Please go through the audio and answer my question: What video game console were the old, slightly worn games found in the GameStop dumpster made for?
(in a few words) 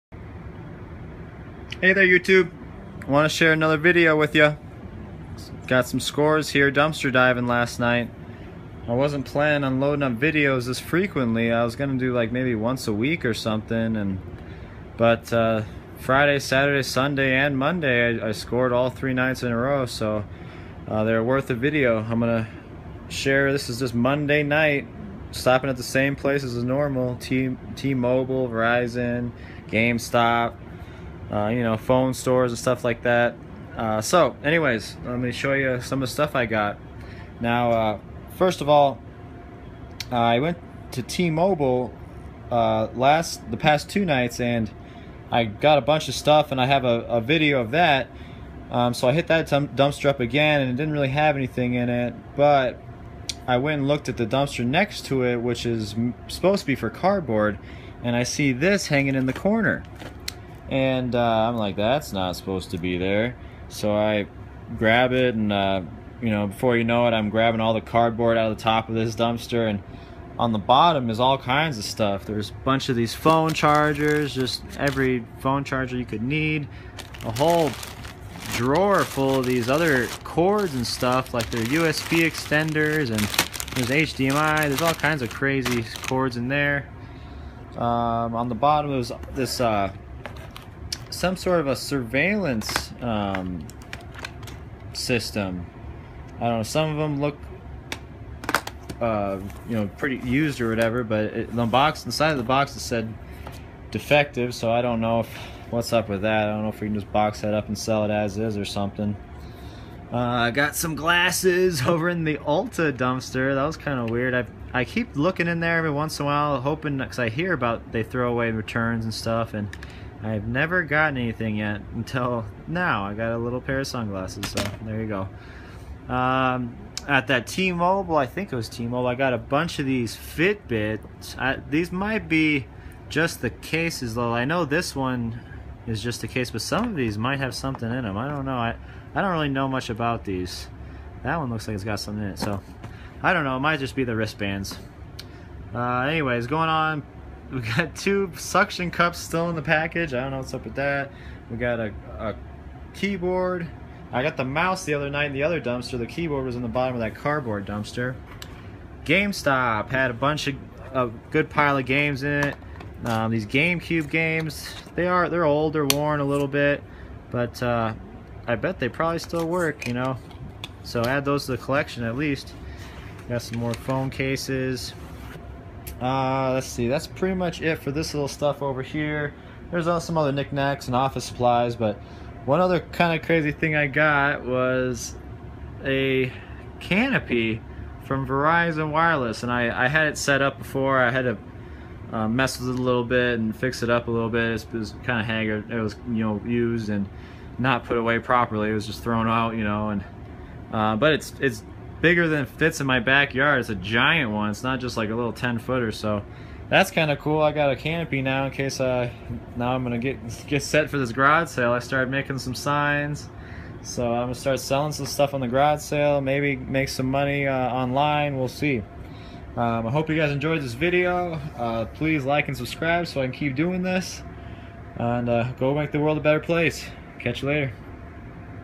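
GameCube.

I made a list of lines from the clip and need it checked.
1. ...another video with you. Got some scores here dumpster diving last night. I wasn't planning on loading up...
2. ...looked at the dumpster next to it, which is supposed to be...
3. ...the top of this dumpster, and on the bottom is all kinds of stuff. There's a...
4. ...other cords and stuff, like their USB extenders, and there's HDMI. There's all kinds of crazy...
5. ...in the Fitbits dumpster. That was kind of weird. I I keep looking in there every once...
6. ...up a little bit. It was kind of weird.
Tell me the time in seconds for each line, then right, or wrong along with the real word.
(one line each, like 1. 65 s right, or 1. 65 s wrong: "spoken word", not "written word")
1. 3 s right
2. 53 s right
3. 68 s right
4. 79 s right
5. 112 s wrong: "Ulta", not "Fitbits"
6. 193 s wrong: "haggard", not "weird".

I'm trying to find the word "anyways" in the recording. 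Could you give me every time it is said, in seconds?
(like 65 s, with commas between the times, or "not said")
34 s, 146 s.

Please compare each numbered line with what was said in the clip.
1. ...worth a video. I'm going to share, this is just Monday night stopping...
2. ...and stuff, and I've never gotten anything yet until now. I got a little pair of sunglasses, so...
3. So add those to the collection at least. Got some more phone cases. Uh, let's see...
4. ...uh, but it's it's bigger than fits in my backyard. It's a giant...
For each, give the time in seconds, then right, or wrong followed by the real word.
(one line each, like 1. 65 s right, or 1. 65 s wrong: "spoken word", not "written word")
1. 21 s right
2. 119 s right
3. 170 s right
4. 200 s right.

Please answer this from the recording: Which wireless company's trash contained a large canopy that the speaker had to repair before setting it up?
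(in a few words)
Verizon Wireless.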